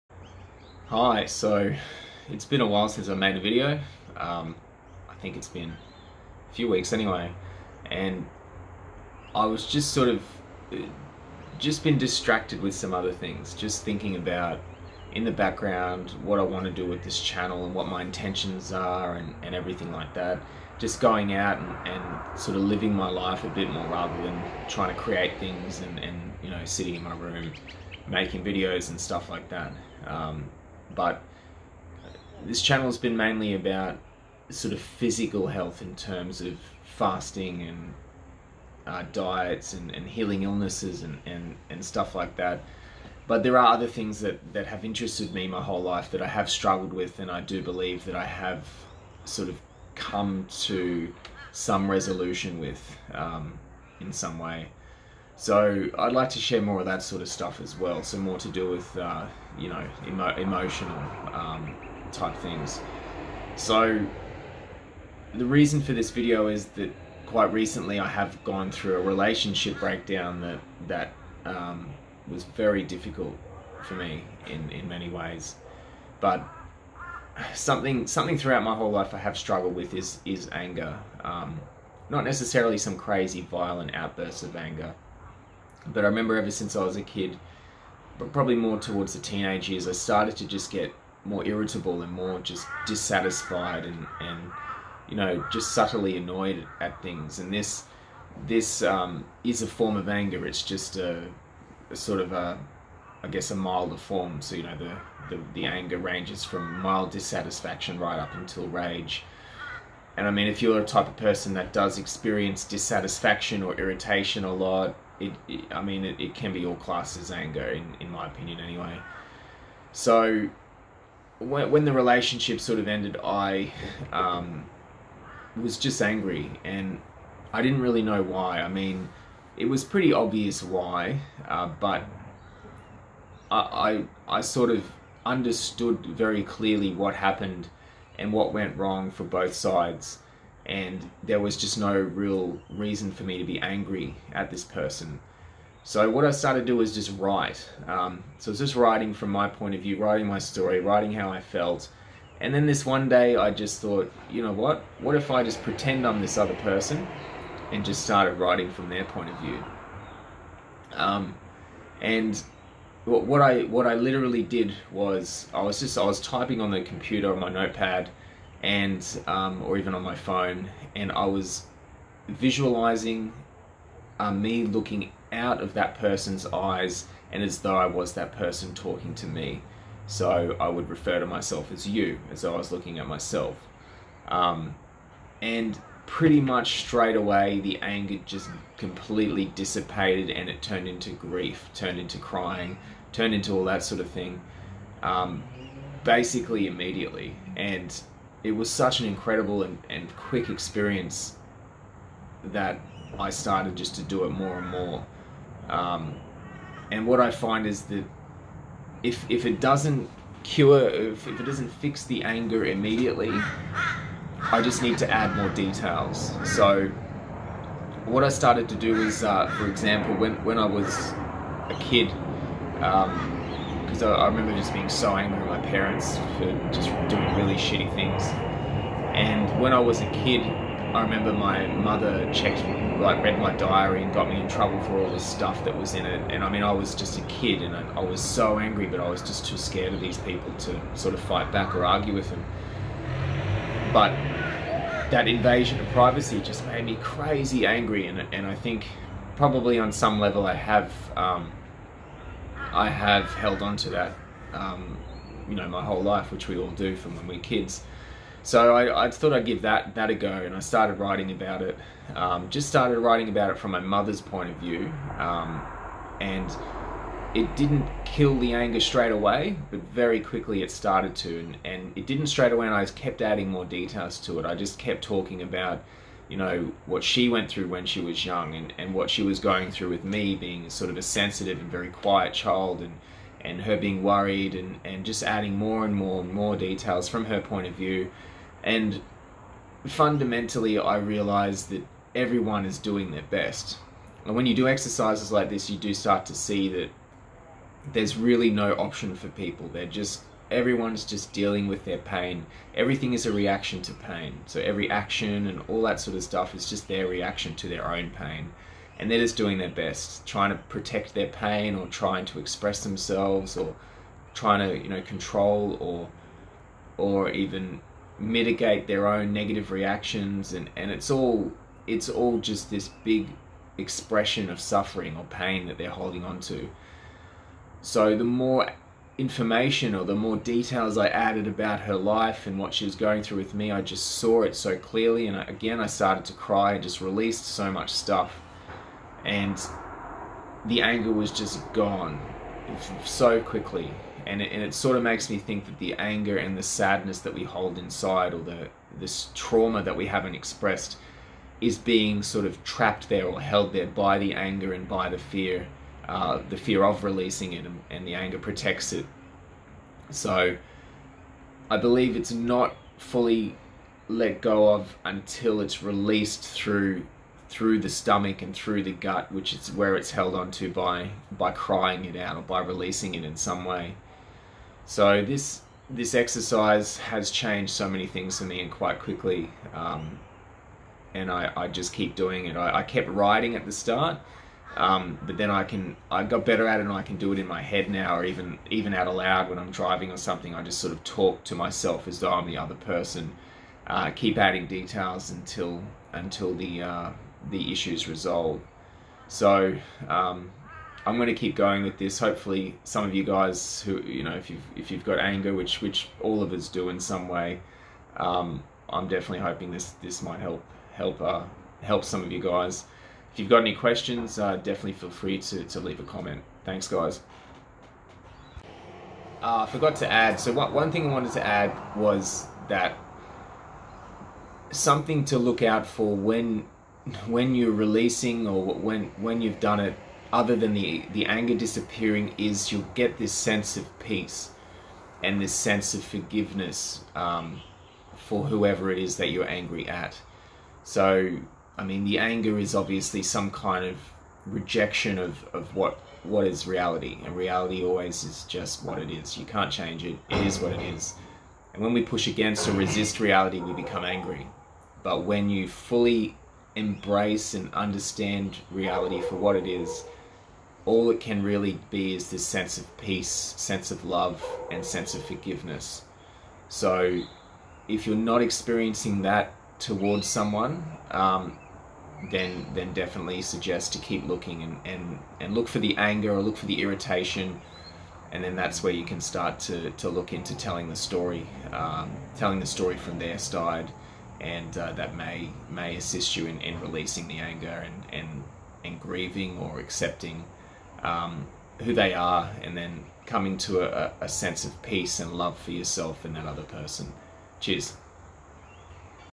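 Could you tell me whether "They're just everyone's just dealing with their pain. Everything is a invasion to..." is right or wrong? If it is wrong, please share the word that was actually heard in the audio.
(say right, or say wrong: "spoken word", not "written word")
wrong: "reaction", not "invasion".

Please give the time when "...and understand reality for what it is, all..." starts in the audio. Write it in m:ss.
7:37.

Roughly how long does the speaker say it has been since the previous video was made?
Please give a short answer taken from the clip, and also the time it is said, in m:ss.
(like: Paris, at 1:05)
a few weeks, at 0:05.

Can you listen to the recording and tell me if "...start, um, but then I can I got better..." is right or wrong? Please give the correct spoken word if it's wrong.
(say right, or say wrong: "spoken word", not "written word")
right.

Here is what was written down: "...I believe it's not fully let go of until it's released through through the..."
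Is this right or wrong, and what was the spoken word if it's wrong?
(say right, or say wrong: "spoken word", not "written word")
right.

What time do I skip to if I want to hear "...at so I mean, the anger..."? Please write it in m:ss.
7:19.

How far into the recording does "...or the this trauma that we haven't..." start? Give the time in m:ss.
5:48.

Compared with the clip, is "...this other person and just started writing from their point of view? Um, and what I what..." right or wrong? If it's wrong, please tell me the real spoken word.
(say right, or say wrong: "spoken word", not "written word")
right.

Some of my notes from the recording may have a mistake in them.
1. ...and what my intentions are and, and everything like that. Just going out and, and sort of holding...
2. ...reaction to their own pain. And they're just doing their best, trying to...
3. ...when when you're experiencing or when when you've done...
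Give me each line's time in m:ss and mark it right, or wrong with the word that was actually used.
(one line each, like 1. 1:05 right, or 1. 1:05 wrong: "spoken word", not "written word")
1. 0:17 wrong: "living", not "holding"
2. 5:07 right
3. 7:06 wrong: "releasing", not "experiencing".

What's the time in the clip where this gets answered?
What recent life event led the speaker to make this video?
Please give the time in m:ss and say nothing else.
1:09.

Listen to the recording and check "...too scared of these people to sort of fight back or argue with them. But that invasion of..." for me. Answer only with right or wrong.
right.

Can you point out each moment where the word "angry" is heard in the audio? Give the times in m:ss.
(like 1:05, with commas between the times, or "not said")
2:06, 2:23, 3:45, 3:58, 4:07, 7:19, 7:34.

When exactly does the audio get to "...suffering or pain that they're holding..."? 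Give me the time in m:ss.
5:24.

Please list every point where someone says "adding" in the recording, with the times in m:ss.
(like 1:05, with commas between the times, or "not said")
4:33, 4:45, 6:34.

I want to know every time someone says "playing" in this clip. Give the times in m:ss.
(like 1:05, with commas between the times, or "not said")
not said.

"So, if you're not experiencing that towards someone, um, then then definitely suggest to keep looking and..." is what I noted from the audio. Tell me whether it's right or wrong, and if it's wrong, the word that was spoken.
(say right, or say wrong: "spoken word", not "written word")
right.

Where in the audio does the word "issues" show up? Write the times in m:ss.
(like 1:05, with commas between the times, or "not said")
6:37.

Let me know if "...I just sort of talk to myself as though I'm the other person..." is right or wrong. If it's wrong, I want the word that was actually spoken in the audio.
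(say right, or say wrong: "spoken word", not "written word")
right.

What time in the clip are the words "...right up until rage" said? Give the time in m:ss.
1:47.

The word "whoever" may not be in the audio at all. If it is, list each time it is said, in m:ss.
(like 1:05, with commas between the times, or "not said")
7:18.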